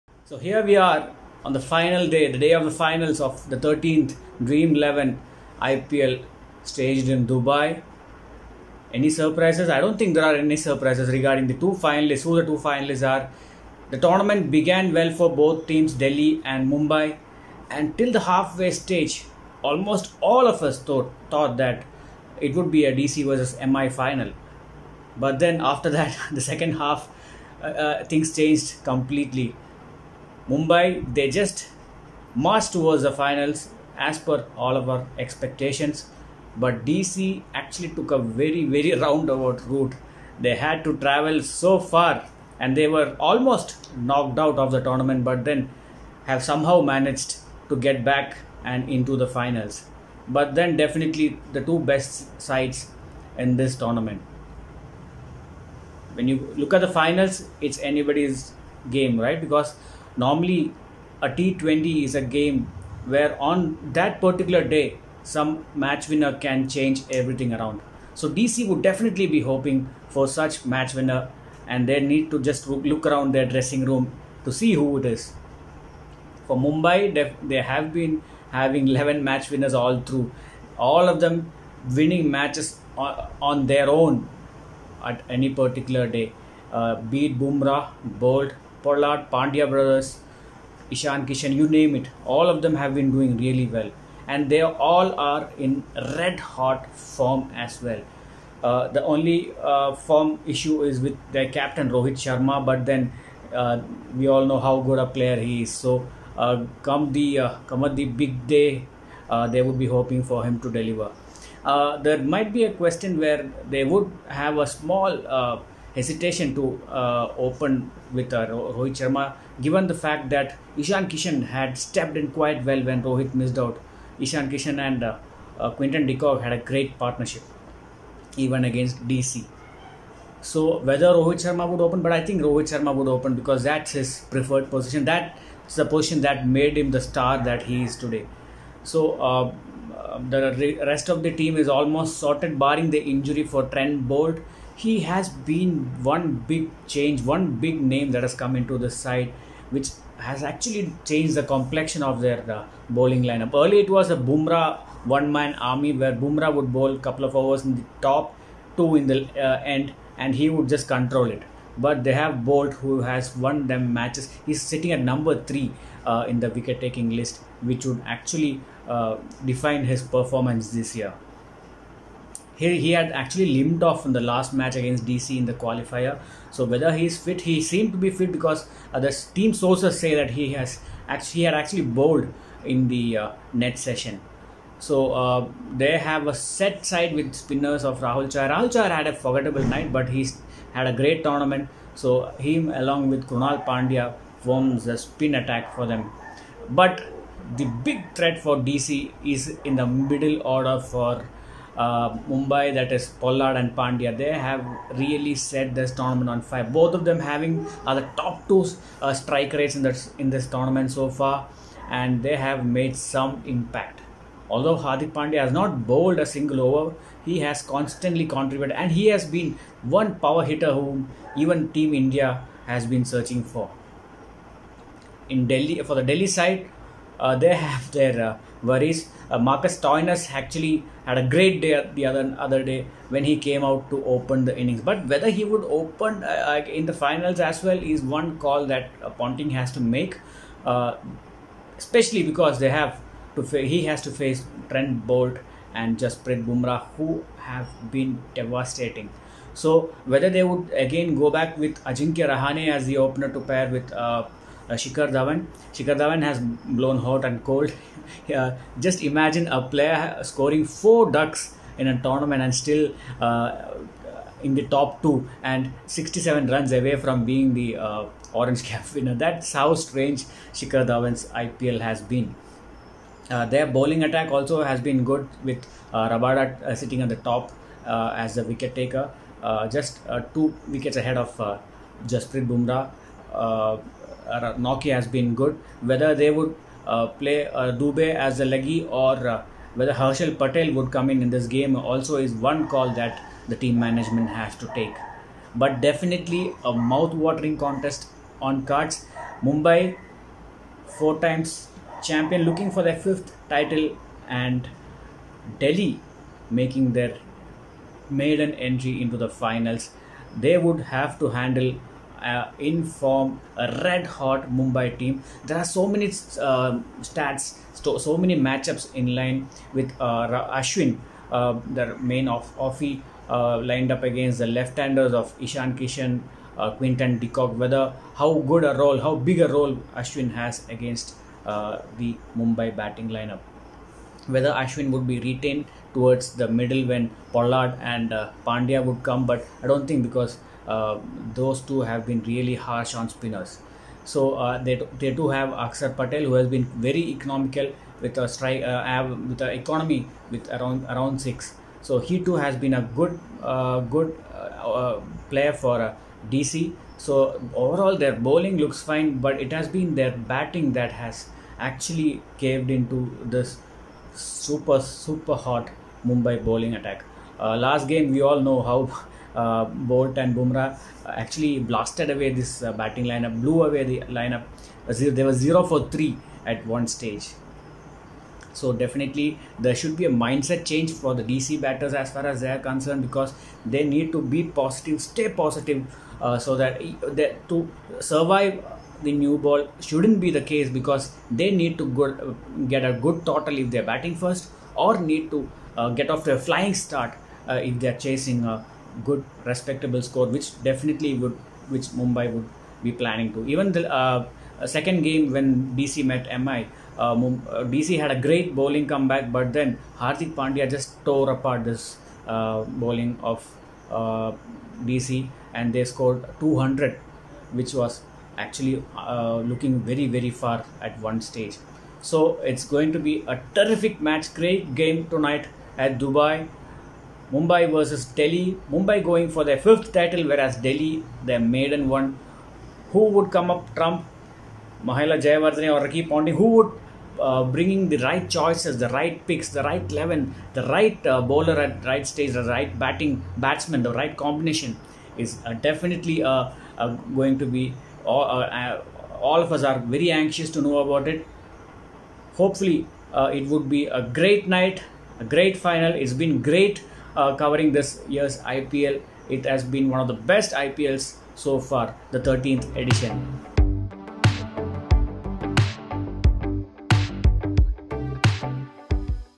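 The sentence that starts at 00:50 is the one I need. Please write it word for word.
But then, definitely, the two best sides in this tournament.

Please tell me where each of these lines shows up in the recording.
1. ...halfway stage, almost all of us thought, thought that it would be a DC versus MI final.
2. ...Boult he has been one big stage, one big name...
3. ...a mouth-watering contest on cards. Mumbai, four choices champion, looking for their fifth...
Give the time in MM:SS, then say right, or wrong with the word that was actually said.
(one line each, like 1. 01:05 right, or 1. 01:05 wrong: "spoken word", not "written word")
1. 00:18 right
2. 02:24 wrong: "change", not "stage"
3. 04:56 wrong: "times", not "choices".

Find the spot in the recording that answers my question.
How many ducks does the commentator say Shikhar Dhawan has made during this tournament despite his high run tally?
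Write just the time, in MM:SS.
04:20.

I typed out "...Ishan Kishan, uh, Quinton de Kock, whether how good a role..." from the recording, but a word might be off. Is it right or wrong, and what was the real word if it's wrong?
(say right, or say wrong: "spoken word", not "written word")
right.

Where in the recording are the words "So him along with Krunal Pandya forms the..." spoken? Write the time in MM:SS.
03:11.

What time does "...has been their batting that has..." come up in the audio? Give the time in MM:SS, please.
05:59.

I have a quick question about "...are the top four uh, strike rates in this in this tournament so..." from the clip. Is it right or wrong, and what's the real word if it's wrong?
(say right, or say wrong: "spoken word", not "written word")
wrong: "two", not "four".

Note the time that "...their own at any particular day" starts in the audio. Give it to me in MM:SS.
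01:23.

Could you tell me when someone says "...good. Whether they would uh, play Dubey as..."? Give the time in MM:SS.
04:45.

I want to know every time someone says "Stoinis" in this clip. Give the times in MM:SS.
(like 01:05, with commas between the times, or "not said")
03:49.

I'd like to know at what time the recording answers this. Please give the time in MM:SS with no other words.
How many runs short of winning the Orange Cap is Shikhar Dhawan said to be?
04:25.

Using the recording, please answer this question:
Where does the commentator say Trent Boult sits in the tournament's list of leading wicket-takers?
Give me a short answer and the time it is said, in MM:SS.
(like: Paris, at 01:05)
number three, at 02:45.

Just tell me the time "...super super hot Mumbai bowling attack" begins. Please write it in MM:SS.
06:04.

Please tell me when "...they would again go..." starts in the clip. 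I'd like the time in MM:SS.
04:10.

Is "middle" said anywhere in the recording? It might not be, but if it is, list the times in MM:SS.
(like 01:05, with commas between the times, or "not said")
03:19, 05:36.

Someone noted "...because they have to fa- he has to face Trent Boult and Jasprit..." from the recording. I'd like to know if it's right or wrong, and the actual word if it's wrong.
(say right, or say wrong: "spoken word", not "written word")
right.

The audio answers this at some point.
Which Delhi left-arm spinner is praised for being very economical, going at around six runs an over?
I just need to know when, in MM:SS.
05:45.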